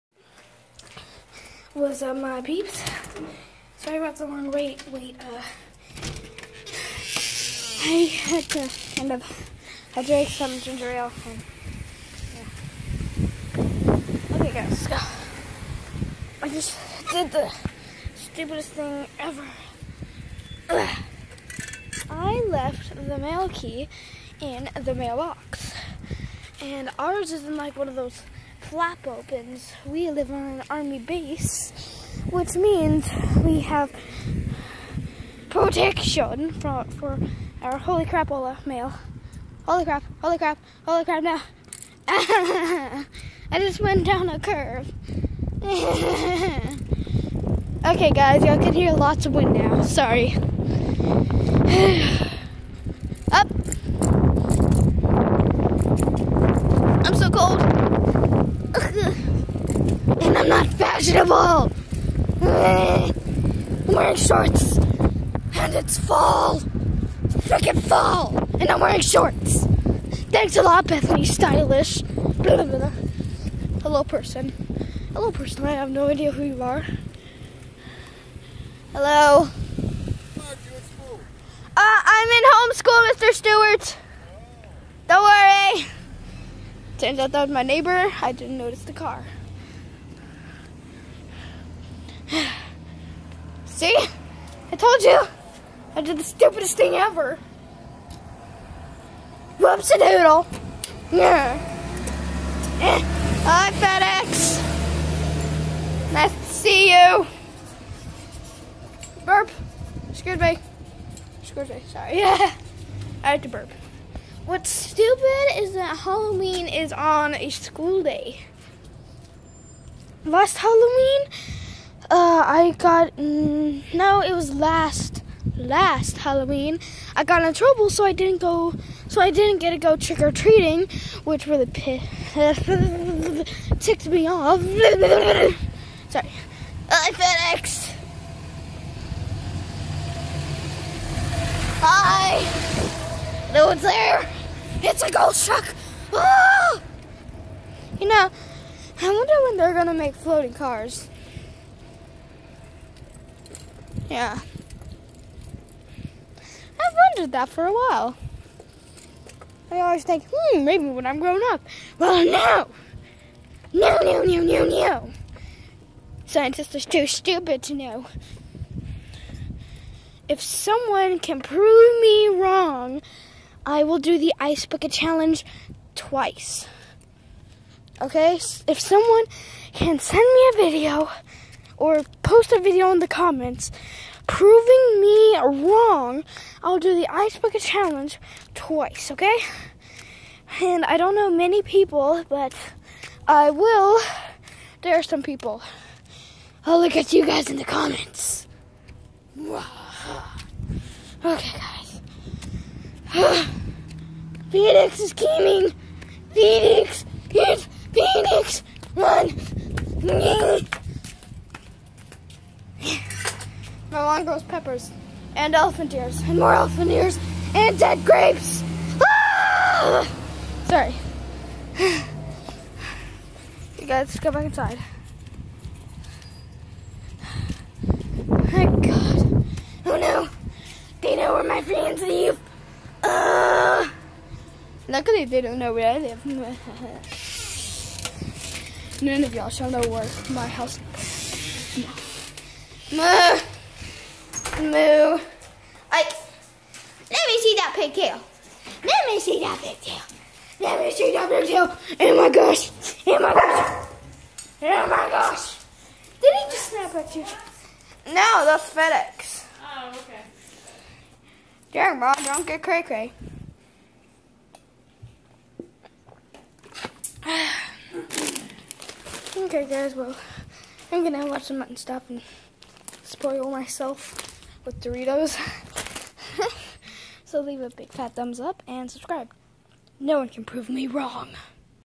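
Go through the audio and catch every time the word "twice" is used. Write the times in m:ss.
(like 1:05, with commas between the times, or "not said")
2:55, 3:08.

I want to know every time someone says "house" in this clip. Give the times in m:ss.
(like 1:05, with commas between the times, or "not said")
4:00.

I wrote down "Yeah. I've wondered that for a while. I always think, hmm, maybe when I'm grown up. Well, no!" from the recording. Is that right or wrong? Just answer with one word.
right.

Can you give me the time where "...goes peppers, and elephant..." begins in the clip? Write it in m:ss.
3:34.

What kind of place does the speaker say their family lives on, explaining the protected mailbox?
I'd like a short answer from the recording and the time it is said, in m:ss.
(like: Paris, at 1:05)
army base, at 0:30.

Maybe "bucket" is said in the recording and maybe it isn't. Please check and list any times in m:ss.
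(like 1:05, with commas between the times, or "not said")
2:54, 3:07.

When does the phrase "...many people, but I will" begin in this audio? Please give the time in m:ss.
3:11.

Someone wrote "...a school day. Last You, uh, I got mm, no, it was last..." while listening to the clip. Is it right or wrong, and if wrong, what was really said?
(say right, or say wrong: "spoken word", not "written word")
wrong: "Halloween", not "You".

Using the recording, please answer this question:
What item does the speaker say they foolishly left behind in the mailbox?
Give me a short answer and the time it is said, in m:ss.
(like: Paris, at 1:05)
mail key, at 0:23.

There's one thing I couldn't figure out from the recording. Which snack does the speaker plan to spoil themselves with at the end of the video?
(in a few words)
Doritos.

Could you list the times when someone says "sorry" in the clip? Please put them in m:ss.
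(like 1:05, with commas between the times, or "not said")
0:03, 0:49, 1:51, 2:16, 3:40.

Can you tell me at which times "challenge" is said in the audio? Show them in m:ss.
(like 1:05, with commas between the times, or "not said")
2:54, 3:07.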